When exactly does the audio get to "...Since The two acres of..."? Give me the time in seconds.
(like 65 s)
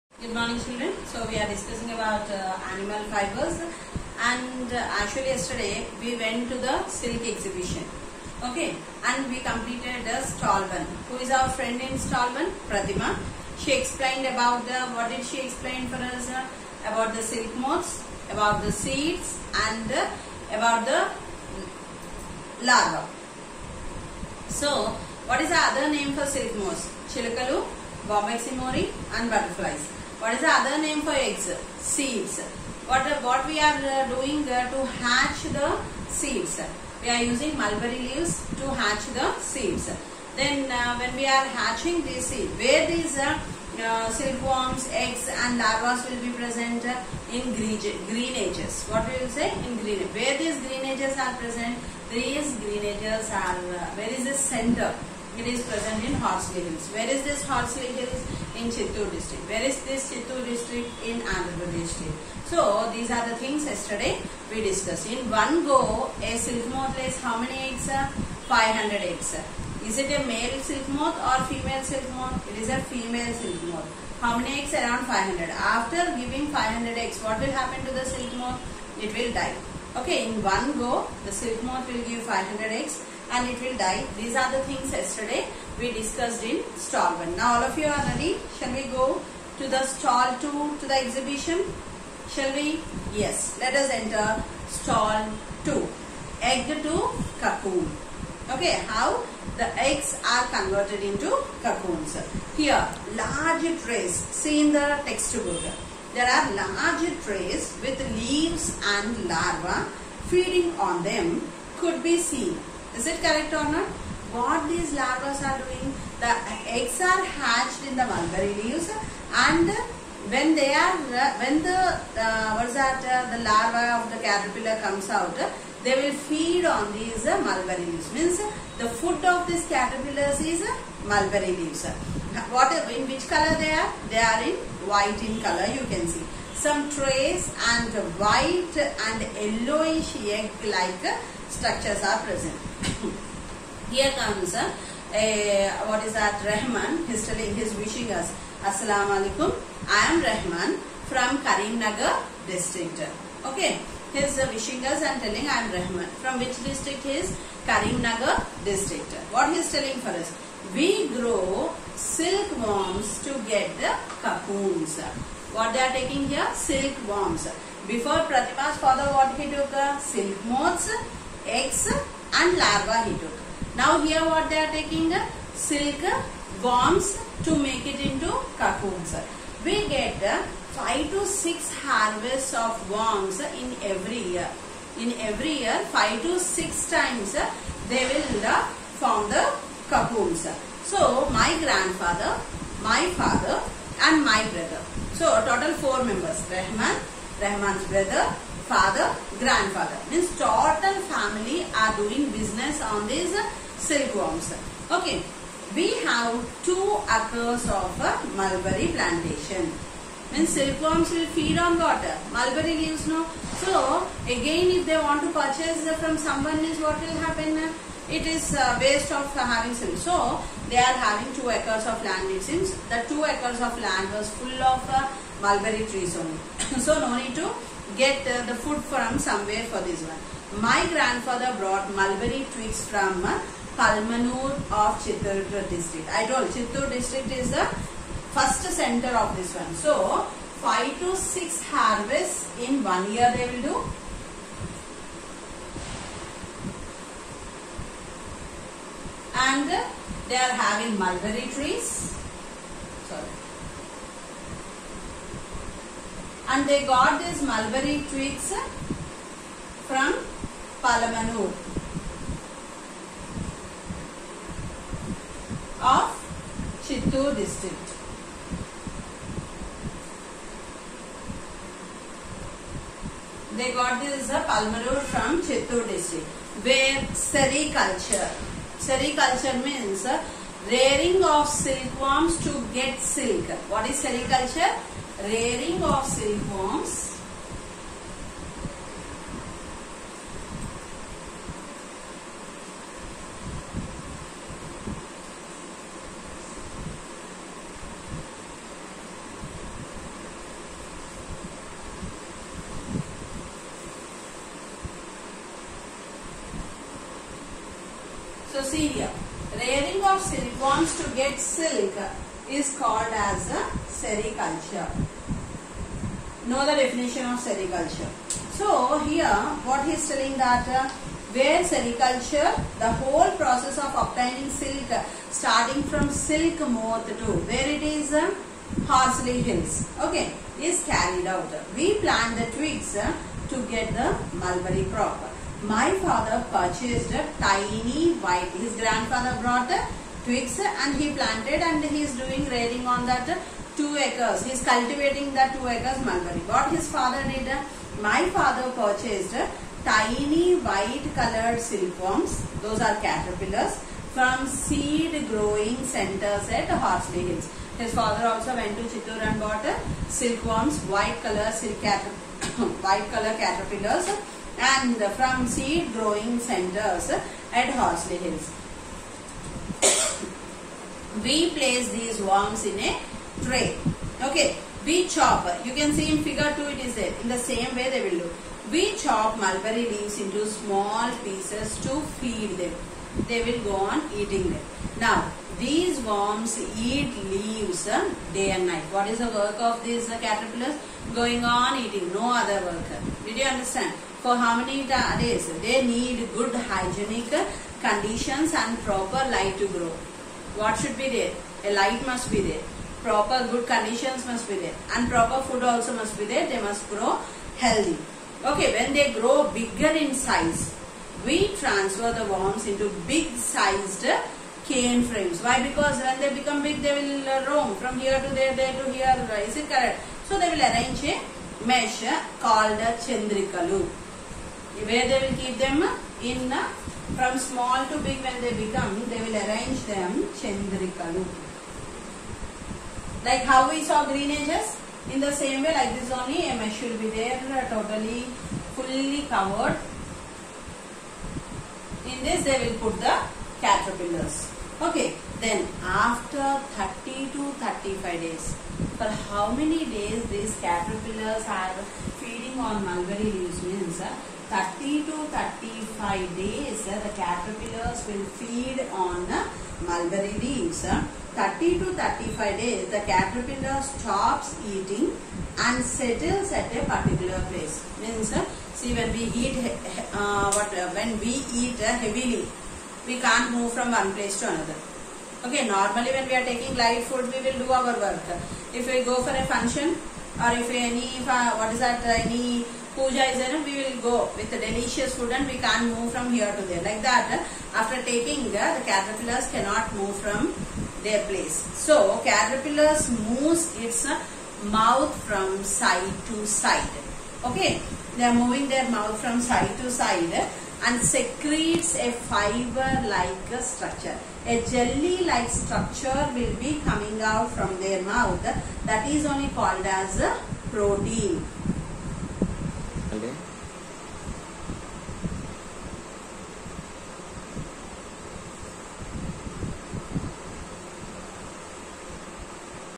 222 s.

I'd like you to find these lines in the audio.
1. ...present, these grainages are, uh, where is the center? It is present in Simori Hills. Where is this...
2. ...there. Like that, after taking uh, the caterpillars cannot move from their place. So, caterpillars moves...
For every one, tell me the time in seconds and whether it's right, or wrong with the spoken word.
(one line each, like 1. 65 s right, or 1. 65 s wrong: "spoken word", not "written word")
1. 51 s wrong: "Horsley", not "Simori"
2. 486 s right.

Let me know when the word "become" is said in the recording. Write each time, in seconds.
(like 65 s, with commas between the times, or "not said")
416 s, 428 s.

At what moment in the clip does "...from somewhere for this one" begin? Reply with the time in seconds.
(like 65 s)
228 s.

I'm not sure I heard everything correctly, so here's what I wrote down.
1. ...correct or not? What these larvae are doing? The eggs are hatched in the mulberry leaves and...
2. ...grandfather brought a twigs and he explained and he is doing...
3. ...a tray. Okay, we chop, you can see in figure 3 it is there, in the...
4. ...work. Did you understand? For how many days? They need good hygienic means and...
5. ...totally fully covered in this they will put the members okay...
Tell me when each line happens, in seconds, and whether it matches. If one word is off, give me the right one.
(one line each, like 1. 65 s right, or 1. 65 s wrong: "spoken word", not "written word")
1. 113 s right
2. 338 s wrong: "planted", not "explained"
3. 372 s wrong: "2", not "3"
4. 392 s wrong: "conditions", not "means"
5. 437 s wrong: "caterpillars", not "members".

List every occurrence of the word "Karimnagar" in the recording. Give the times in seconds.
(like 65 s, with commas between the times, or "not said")
151 s, 157 s.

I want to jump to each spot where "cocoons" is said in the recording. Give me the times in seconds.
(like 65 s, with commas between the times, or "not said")
97 s, 101 s, 164 s, 178 s, 189 s.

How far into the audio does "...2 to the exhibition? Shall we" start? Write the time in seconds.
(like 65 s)
90 s.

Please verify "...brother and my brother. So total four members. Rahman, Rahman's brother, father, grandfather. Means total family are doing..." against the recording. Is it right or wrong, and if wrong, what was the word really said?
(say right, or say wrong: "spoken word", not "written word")
wrong: "father", not "brother".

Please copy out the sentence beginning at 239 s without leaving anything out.
So 5 to 6 harvests in one year they will do and they are having mulberry trees.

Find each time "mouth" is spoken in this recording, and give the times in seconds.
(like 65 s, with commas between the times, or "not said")
494 s, 498 s, 508 s.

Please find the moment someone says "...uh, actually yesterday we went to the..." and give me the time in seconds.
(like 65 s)
4 s.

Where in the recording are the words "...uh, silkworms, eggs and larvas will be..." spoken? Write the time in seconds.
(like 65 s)
43 s.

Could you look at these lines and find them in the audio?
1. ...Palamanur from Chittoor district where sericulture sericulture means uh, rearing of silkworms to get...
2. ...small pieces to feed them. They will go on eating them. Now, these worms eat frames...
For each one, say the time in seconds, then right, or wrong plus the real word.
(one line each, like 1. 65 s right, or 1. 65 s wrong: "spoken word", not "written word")
1. 274 s right
2. 380 s wrong: "leaves", not "frames".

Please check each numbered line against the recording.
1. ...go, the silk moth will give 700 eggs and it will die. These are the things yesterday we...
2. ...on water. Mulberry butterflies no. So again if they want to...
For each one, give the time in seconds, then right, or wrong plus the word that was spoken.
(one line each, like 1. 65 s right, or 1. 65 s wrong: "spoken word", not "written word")
1. 80 s wrong: "500", not "700"
2. 211 s wrong: "leaves", not "butterflies".